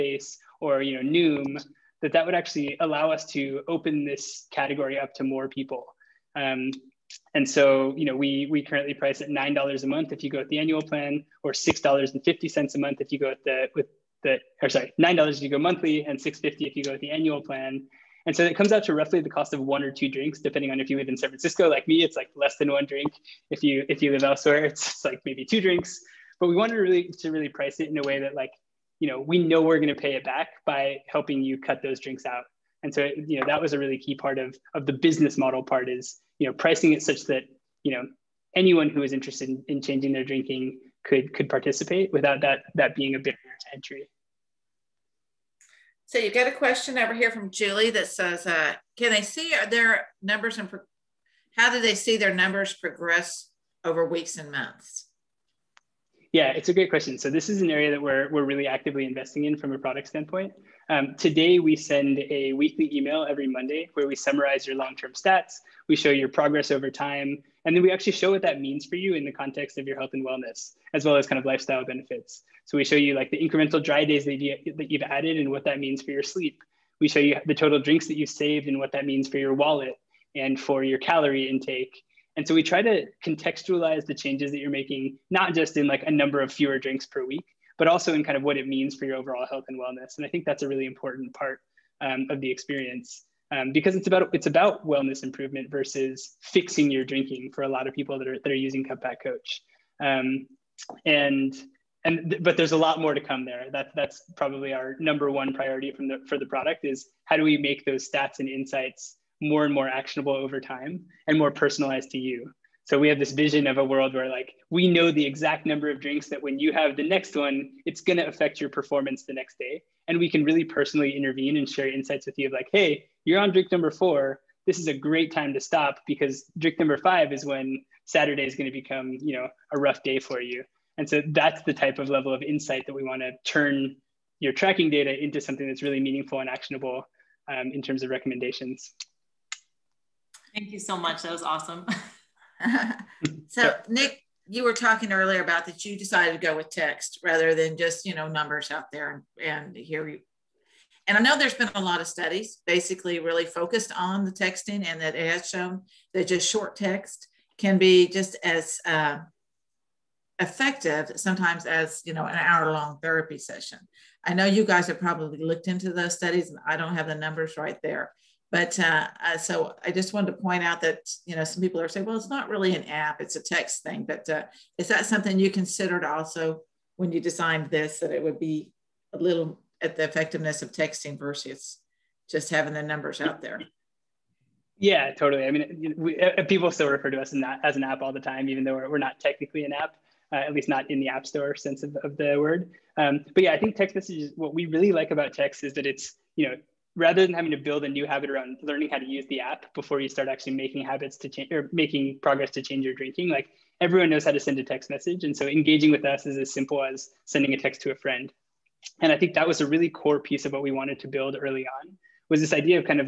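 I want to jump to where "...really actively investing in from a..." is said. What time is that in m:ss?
0:58.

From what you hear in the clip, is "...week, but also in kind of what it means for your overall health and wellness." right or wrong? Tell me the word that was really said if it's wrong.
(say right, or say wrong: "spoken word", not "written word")
right.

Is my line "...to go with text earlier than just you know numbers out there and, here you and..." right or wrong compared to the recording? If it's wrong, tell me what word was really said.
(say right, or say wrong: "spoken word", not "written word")
wrong: "rather", not "earlier".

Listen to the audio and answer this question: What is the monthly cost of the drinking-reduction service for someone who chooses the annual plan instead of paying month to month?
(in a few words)
$6.50.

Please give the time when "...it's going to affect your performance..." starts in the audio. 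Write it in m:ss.
1:57.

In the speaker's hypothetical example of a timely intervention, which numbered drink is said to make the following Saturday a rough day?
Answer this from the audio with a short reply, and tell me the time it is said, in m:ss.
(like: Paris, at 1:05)
5, at 2:06.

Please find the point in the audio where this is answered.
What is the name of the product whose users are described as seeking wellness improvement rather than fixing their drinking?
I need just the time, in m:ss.
1:38.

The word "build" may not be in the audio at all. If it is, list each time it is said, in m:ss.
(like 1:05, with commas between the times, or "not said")
3:17, 3:31.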